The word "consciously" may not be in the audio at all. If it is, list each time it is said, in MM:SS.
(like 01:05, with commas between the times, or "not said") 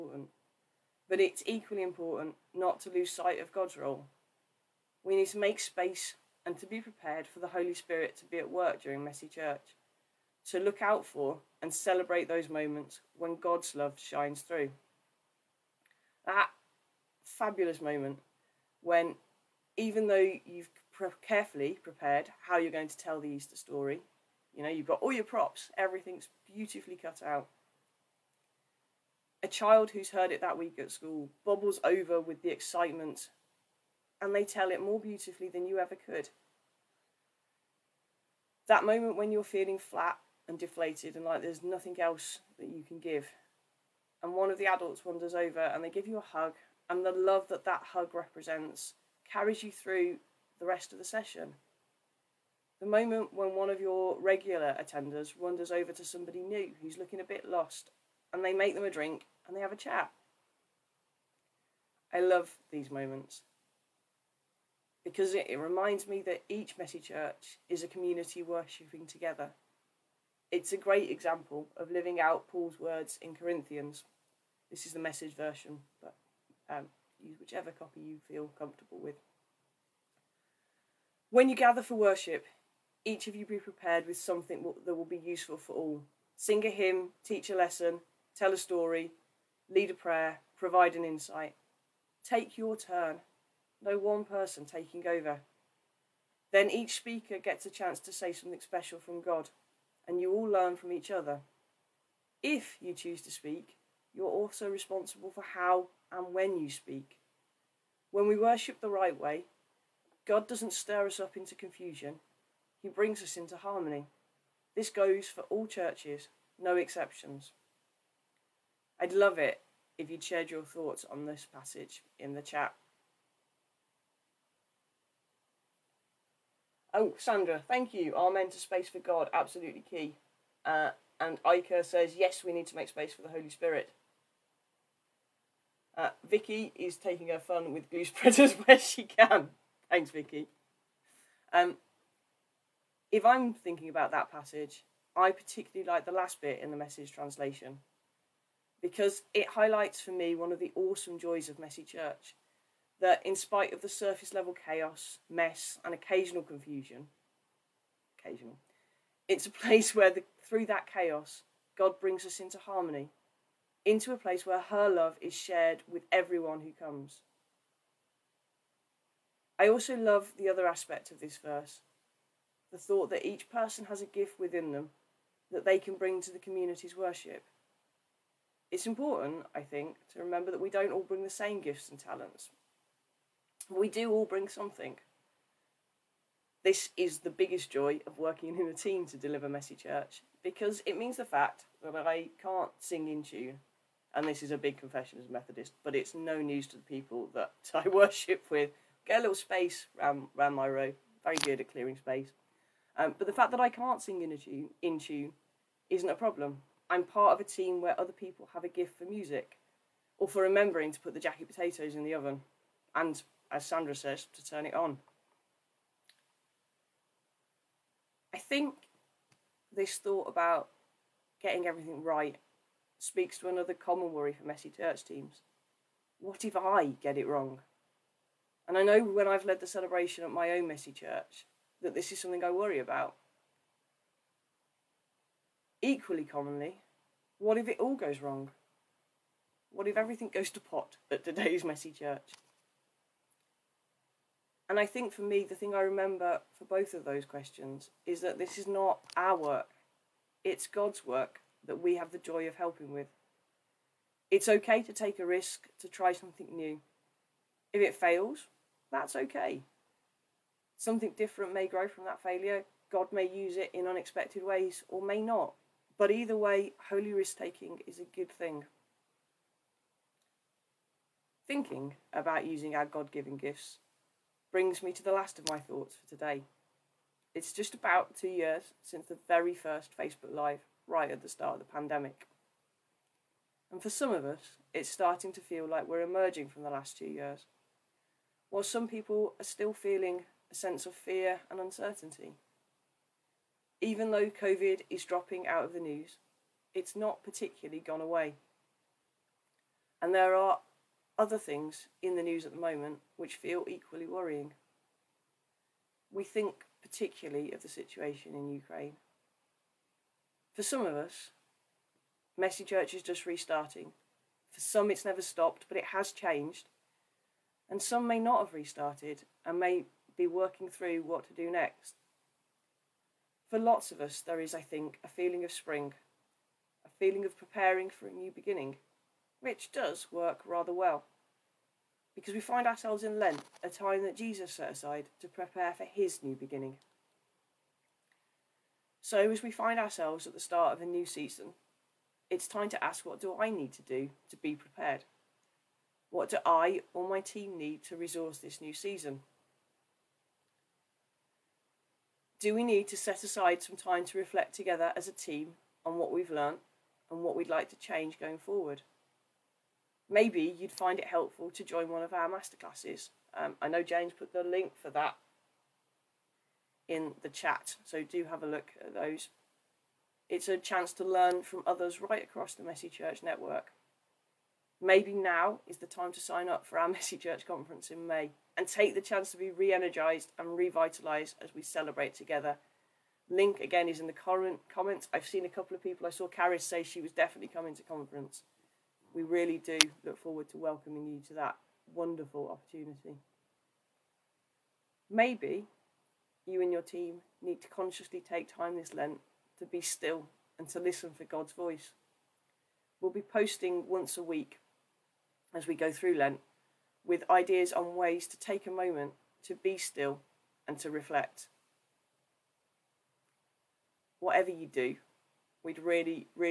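06:37.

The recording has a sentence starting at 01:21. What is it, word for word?
When you gather for worship, each of you be prepared with something that will be useful for all.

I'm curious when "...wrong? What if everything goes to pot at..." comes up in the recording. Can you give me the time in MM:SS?
03:58.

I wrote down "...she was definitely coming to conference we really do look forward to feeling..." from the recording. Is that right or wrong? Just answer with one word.
wrong.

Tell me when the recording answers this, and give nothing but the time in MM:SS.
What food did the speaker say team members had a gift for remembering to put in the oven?
03:31.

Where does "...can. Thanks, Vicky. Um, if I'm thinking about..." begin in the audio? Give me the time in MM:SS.
02:19.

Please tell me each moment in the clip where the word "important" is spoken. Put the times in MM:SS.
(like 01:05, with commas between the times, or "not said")
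00:01, 02:58.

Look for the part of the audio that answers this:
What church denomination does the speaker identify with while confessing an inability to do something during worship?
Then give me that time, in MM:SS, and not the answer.
03:15.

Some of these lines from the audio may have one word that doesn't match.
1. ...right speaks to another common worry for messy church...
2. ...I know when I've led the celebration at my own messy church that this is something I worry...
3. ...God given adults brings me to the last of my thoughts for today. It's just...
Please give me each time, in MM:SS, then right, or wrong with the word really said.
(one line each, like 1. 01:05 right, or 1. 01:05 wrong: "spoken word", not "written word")
1. 03:42 right
2. 03:48 right
3. 04:32 wrong: "gifts", not "adults".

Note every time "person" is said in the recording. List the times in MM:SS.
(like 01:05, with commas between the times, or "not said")
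01:34, 02:53.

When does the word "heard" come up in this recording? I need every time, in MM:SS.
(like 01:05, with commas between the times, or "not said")
00:30.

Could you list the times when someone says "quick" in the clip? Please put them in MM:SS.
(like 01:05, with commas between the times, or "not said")
not said.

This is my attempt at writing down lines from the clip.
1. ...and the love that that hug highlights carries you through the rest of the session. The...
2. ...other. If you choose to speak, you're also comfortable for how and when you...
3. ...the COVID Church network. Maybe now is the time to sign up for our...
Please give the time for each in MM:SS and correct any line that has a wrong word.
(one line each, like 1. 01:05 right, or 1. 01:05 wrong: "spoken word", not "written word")
1. 00:46 wrong: "represents", not "highlights"
2. 01:41 wrong: "responsible", not "comfortable"
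3. 06:12 wrong: "Messy", not "COVID".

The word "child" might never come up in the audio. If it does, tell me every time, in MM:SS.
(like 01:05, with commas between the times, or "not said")
00:29.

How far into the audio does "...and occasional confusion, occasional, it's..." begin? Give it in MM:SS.
02:35.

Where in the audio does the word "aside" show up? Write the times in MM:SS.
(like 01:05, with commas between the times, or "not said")
05:34, 05:53.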